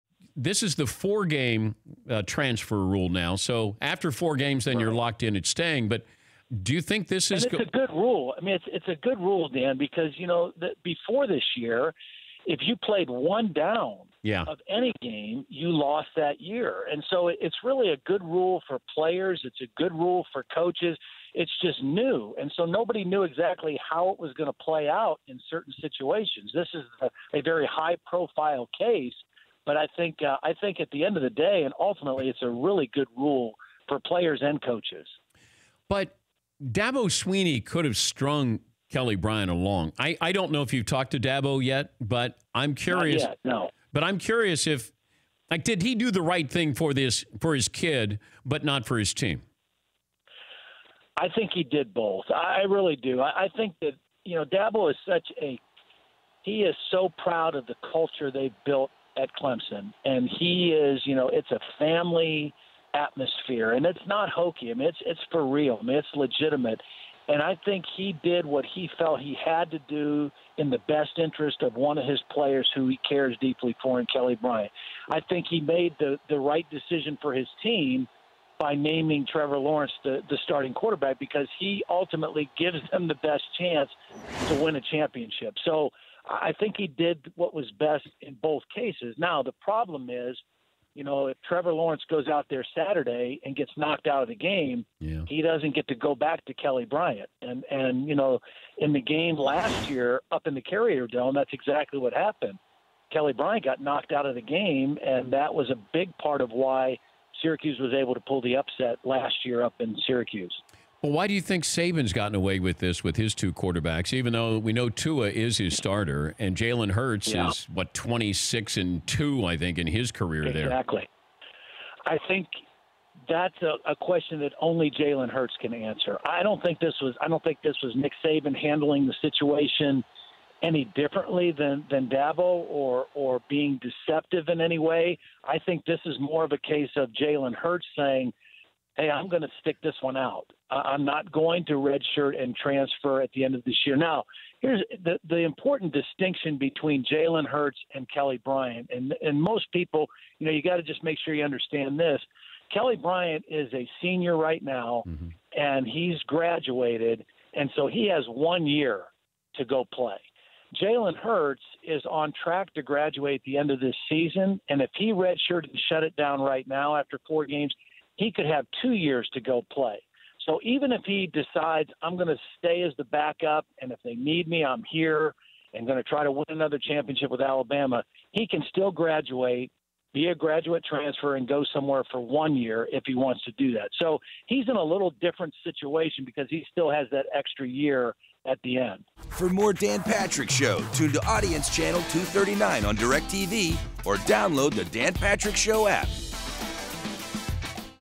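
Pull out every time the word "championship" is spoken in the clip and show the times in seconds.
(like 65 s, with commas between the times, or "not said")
84 s, 176 s.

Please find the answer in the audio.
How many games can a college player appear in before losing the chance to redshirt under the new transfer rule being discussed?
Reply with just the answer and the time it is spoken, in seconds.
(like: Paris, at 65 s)
4, at 0 s.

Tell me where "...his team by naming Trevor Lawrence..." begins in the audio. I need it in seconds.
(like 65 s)
77 s.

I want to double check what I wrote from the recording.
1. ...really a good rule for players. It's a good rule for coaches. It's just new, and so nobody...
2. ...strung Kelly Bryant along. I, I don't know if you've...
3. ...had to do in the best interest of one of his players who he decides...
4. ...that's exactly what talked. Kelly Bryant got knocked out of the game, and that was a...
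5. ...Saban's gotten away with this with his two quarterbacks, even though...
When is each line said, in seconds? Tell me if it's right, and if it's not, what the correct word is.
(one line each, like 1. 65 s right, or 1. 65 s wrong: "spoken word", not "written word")
1. 17 s right
2. 37 s right
3. 69 s wrong: "cares", not "decides"
4. 101 s wrong: "happened", not "talked"
5. 111 s right.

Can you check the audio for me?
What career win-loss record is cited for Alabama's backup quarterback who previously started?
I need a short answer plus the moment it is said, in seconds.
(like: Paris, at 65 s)
26 and 2, at 117 s.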